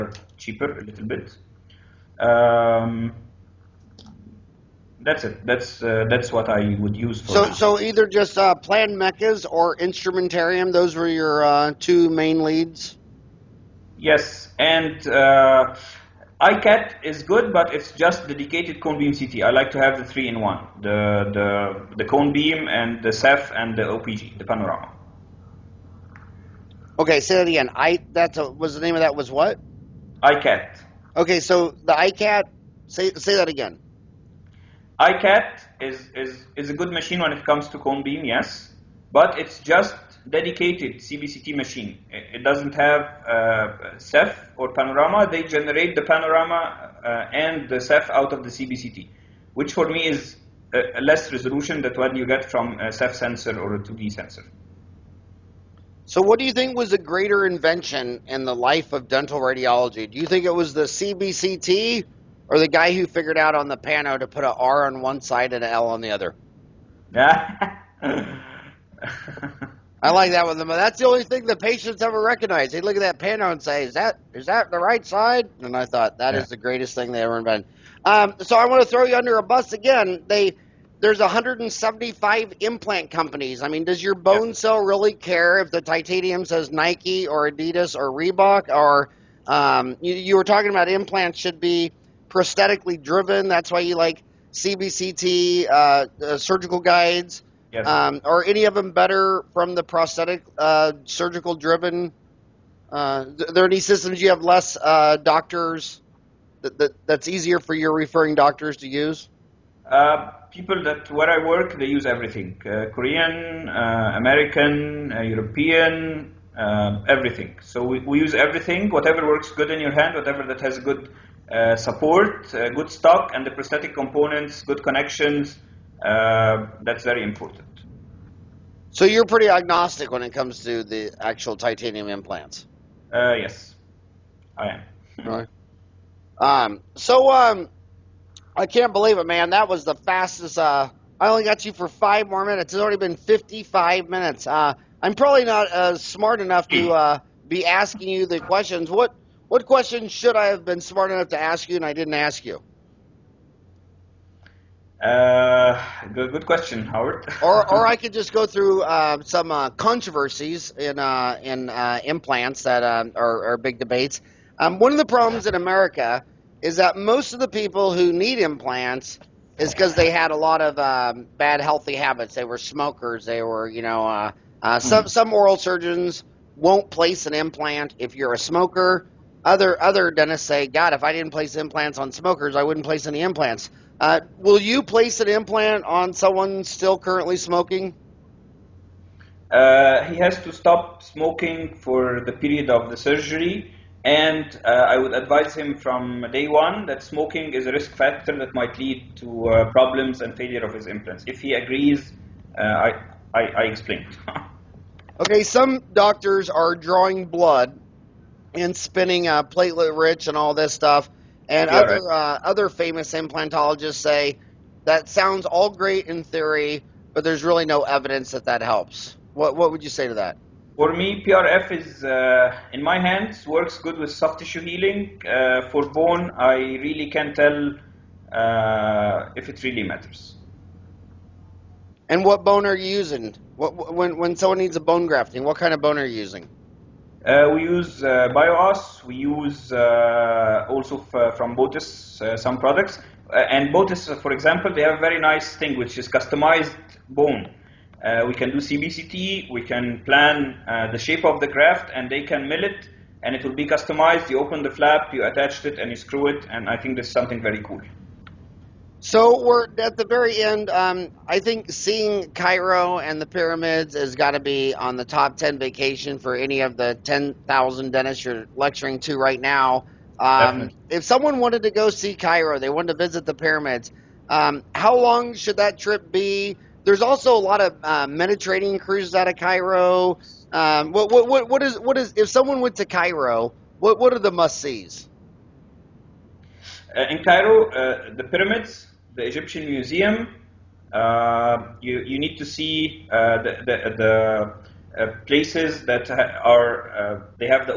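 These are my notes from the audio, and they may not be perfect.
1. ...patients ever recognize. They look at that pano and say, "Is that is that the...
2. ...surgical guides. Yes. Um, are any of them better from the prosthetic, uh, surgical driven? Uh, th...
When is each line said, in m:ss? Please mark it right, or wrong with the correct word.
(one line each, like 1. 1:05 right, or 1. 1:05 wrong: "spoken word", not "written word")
1. 1:11 right
2. 1:36 right.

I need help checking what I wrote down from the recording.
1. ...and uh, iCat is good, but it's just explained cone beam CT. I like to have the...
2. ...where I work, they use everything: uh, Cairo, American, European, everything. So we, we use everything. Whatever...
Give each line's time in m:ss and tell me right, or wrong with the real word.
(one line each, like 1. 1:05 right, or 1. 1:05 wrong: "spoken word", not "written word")
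1. 0:14 wrong: "dedicated", not "explained"
2. 1:51 wrong: "Korean", not "Cairo".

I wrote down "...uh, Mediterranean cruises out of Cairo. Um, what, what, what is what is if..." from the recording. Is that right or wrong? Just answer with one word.
right.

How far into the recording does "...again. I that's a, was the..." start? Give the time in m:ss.
0:27.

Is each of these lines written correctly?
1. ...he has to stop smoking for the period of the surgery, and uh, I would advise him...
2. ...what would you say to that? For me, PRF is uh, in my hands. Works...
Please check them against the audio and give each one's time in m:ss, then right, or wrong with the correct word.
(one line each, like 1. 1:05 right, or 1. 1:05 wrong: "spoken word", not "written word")
1. 3:10 right
2. 3:39 right.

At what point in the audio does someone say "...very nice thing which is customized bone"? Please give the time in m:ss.
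4:05.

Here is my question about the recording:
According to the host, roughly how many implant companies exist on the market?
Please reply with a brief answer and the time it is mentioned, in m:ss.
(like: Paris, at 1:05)
175, at 1:21.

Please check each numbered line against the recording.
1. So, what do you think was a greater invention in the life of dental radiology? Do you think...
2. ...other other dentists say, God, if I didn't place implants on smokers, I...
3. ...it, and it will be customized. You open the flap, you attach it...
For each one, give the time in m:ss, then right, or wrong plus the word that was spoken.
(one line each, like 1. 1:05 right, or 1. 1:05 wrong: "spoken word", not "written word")
1. 0:56 right
2. 2:59 right
3. 4:12 right.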